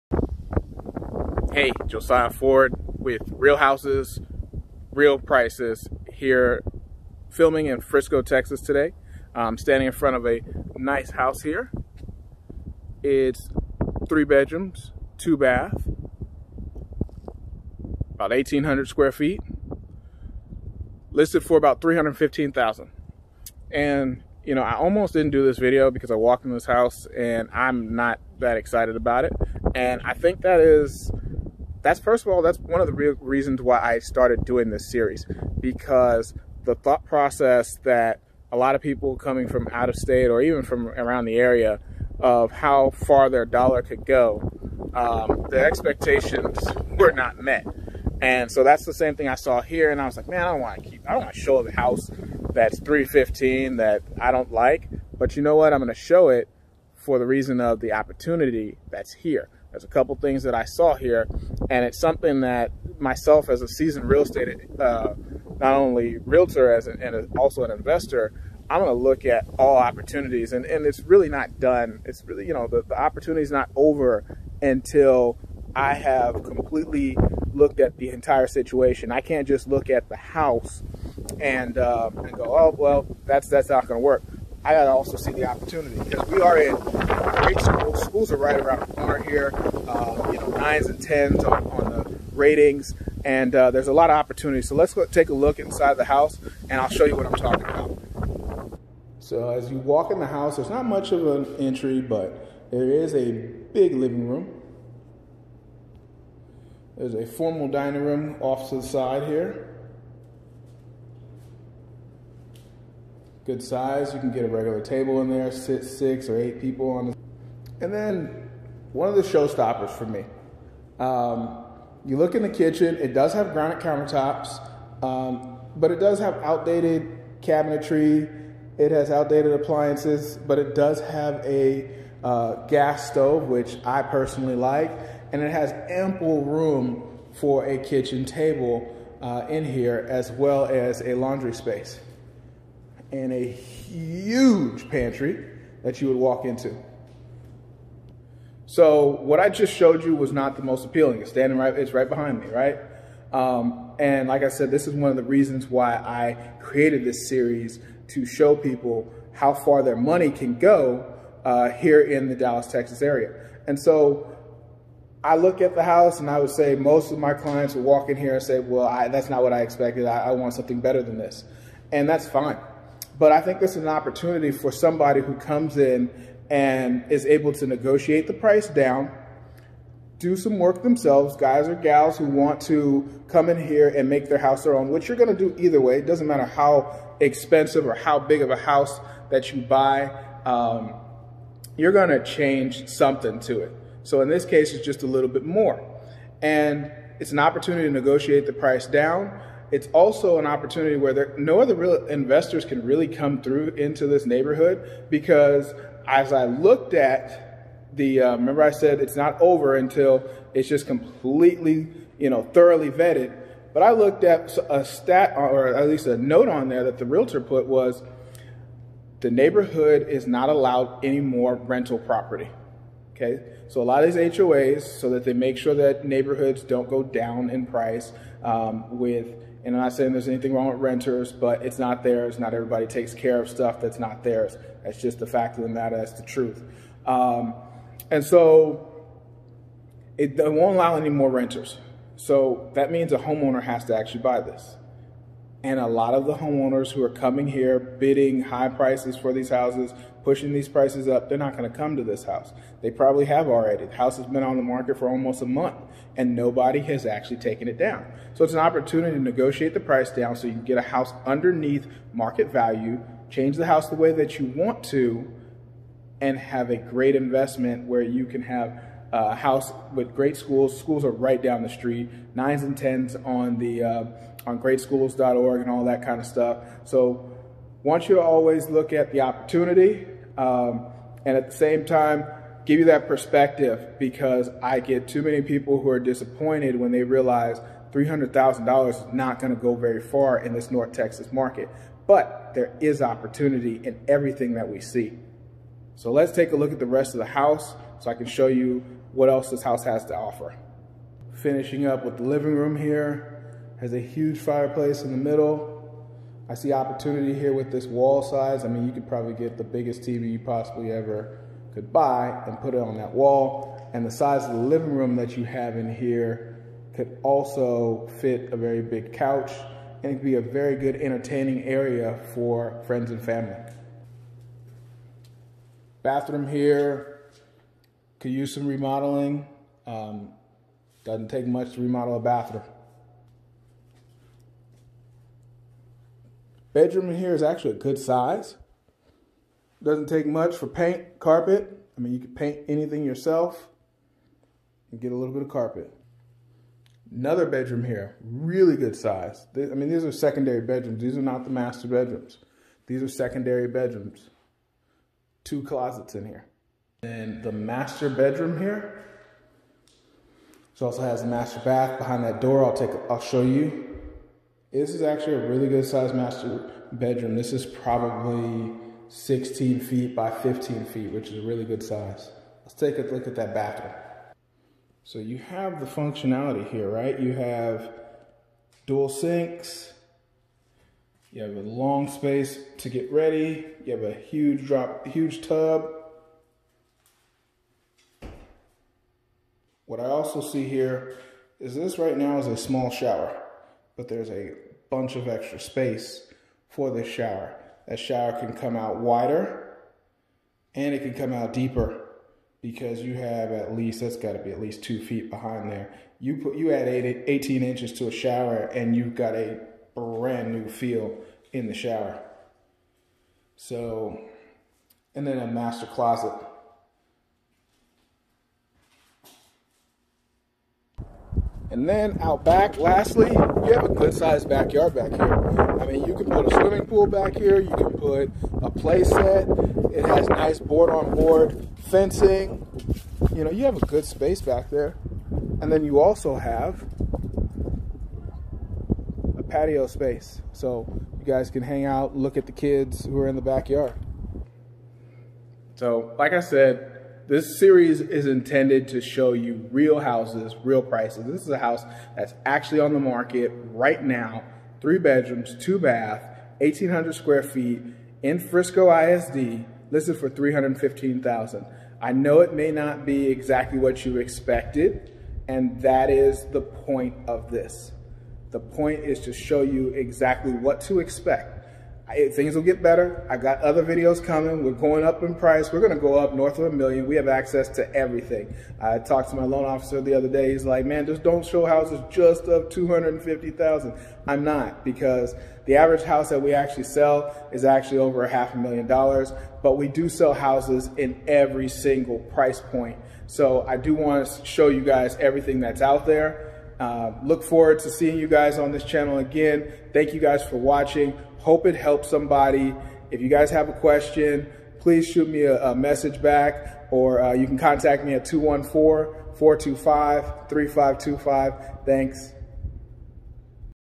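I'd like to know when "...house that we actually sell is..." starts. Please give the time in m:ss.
8:06.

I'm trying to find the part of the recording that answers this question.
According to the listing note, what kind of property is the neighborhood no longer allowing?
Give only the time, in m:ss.
3:41.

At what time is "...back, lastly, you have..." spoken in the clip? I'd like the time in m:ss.
7:02.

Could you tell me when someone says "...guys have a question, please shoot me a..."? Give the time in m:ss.
8:23.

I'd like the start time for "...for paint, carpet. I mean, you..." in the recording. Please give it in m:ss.
5:40.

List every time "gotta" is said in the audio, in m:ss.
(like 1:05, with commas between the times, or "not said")
1:24, 6:44.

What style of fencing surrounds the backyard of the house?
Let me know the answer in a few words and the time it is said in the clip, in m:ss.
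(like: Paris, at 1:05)
Board on board, at 7:10.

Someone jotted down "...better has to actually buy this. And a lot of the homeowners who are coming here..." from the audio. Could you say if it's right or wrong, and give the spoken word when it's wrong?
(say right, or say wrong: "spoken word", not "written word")
wrong: "homeowner", not "better".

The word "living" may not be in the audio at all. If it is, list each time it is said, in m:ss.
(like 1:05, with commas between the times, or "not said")
1:43, 5:02, 5:14.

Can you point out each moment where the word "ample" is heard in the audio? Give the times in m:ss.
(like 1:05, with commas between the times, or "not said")
2:15.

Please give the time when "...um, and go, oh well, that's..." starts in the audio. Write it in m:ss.
1:21.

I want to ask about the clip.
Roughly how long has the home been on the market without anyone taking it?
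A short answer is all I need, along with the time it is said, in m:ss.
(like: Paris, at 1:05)
Almost a month, at 4:15.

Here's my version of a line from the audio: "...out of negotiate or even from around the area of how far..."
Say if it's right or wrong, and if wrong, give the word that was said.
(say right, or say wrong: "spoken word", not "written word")
wrong: "state", not "negotiate".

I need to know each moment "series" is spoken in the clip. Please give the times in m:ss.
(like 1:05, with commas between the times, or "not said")
0:34, 2:37, 7:27.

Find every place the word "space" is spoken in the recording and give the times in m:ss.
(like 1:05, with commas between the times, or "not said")
2:21, 6:22, 6:35, 7:14, 7:19.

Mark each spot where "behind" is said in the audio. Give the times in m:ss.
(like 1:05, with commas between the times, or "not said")
2:32, 6:01, 6:45.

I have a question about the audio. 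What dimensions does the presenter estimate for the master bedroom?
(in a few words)
16 by 15 feet.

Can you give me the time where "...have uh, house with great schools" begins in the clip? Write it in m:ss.
4:28.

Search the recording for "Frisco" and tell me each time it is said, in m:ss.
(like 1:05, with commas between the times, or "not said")
0:07, 7:38.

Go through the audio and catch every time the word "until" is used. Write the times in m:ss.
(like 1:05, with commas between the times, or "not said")
1:14, 3:29.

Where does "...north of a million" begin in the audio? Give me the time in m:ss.
7:56.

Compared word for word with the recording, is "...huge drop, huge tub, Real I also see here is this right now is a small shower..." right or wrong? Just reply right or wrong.
wrong.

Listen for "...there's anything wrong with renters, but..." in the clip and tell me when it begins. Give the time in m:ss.
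3:50.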